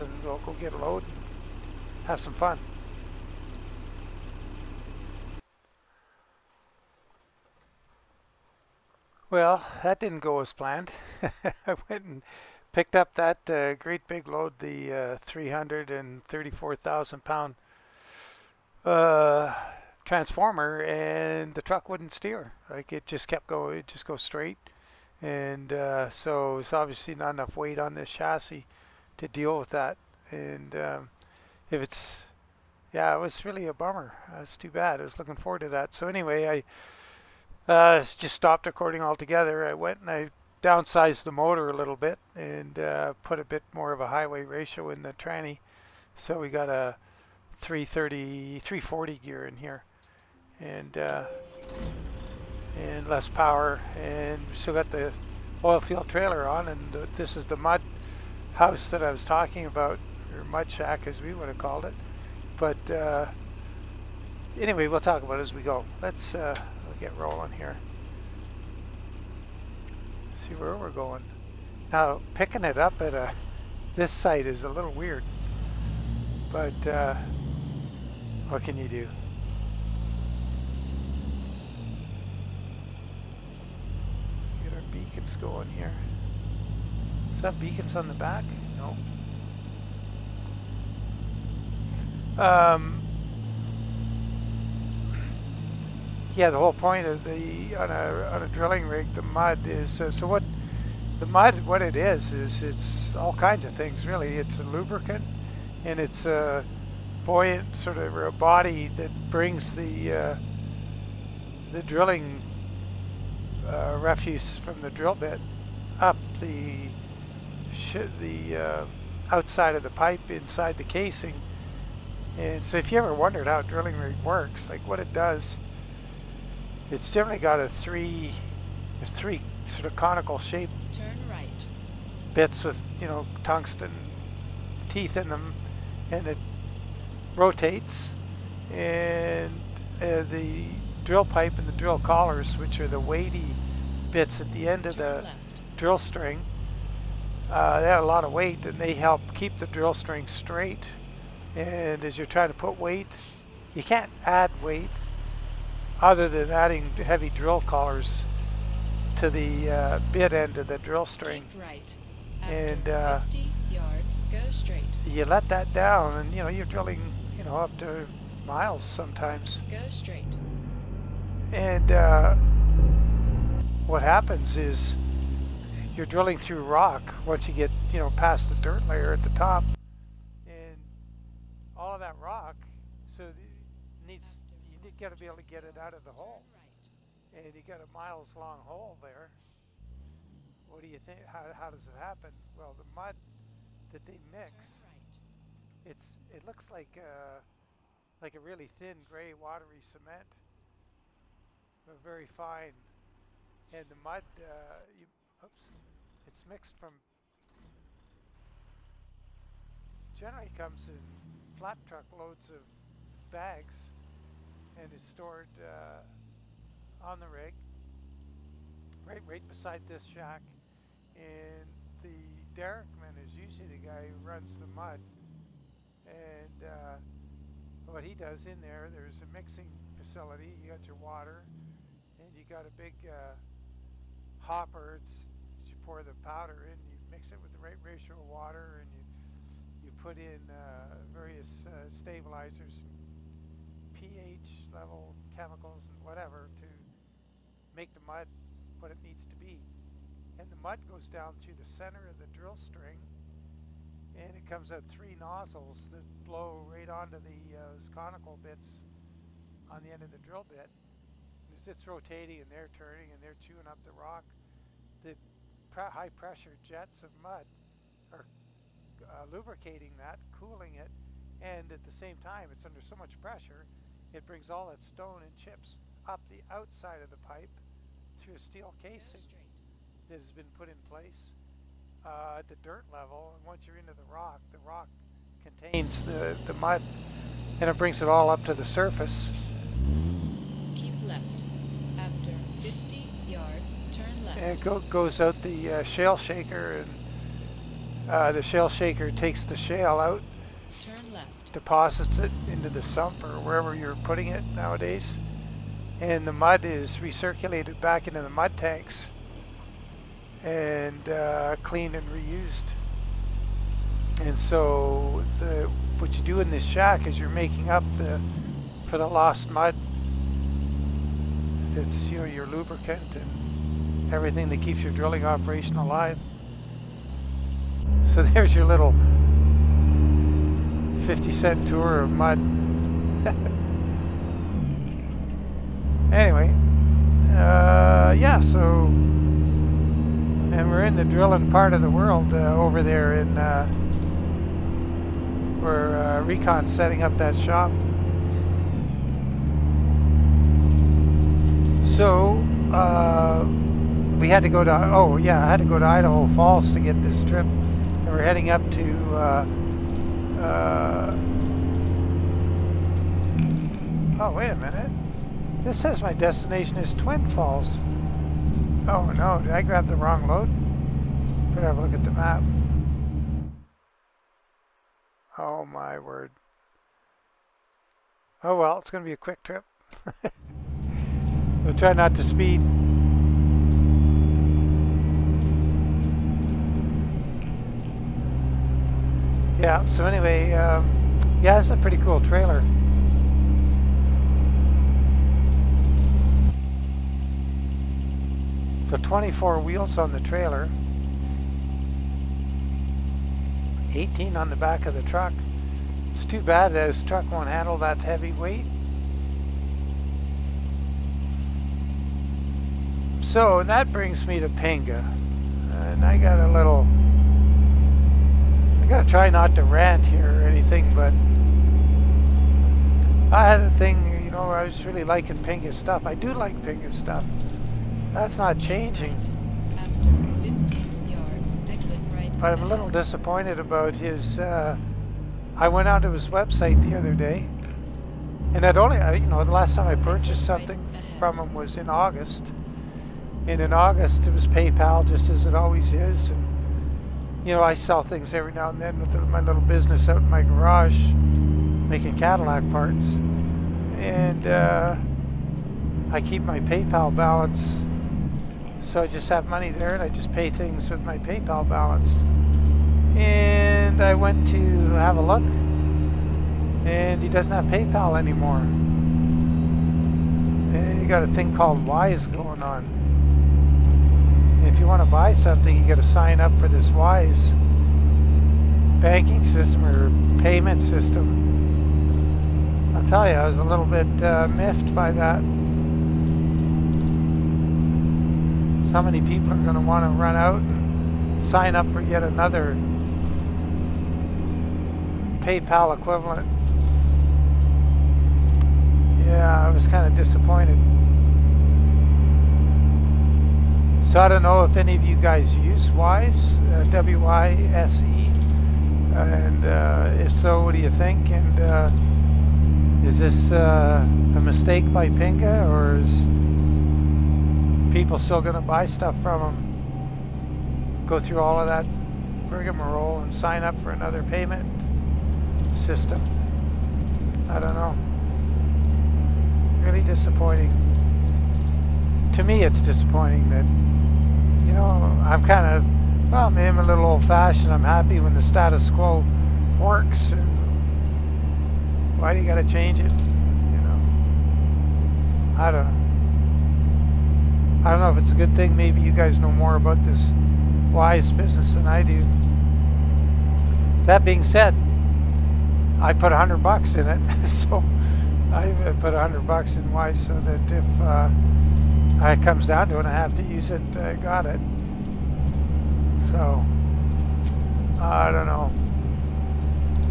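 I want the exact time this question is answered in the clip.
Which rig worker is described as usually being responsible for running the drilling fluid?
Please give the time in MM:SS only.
03:42.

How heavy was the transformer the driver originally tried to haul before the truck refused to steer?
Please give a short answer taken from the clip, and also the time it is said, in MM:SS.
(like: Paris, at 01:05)
334,000 pounds, at 00:15.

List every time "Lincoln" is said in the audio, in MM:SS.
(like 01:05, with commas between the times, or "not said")
not said.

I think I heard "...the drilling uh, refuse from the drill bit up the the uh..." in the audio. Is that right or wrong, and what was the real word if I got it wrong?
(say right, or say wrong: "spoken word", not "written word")
right.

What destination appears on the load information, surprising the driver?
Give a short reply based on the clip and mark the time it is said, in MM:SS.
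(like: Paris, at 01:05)
Twin Falls, at 06:06.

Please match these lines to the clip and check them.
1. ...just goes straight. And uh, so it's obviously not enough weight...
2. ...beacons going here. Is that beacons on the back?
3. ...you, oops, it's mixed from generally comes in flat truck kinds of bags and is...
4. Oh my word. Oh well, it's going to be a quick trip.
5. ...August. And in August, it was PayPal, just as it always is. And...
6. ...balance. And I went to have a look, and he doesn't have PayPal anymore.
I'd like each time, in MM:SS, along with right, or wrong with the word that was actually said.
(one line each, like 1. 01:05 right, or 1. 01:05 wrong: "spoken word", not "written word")
1. 00:23 right
2. 01:24 right
3. 03:24 wrong: "loads", not "kinds"
4. 06:15 right
5. 07:21 right
6. 07:41 right.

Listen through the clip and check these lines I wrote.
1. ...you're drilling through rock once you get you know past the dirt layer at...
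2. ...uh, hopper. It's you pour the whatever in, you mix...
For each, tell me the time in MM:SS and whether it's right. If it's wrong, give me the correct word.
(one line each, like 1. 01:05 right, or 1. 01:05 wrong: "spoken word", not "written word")
1. 02:55 right
2. 03:53 wrong: "powder", not "whatever".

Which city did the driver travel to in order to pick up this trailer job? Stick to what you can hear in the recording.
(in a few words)
Idaho Falls.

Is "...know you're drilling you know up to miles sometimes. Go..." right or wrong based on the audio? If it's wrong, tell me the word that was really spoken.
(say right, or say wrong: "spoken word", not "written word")
right.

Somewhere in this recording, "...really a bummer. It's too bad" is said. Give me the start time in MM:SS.
00:33.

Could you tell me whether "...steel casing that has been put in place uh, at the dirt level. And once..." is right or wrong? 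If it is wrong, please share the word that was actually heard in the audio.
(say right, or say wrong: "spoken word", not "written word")
right.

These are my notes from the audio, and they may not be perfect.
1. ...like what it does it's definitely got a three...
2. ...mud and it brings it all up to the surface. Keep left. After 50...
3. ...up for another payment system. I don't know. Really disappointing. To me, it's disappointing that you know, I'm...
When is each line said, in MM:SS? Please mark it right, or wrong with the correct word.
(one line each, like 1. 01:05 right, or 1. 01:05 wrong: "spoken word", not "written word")
1. 02:04 right
2. 04:46 right
3. 08:43 right.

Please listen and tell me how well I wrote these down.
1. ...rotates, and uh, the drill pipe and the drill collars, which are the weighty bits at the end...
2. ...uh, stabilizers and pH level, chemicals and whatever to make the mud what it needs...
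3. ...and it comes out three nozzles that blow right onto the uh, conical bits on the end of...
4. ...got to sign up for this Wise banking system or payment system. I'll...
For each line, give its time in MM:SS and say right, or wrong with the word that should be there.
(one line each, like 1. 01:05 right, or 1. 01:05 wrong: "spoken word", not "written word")
1. 02:17 right
2. 04:01 right
3. 04:14 right
4. 07:55 right.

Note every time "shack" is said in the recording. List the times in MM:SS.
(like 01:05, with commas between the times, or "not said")
01:00, 03:40, 05:16.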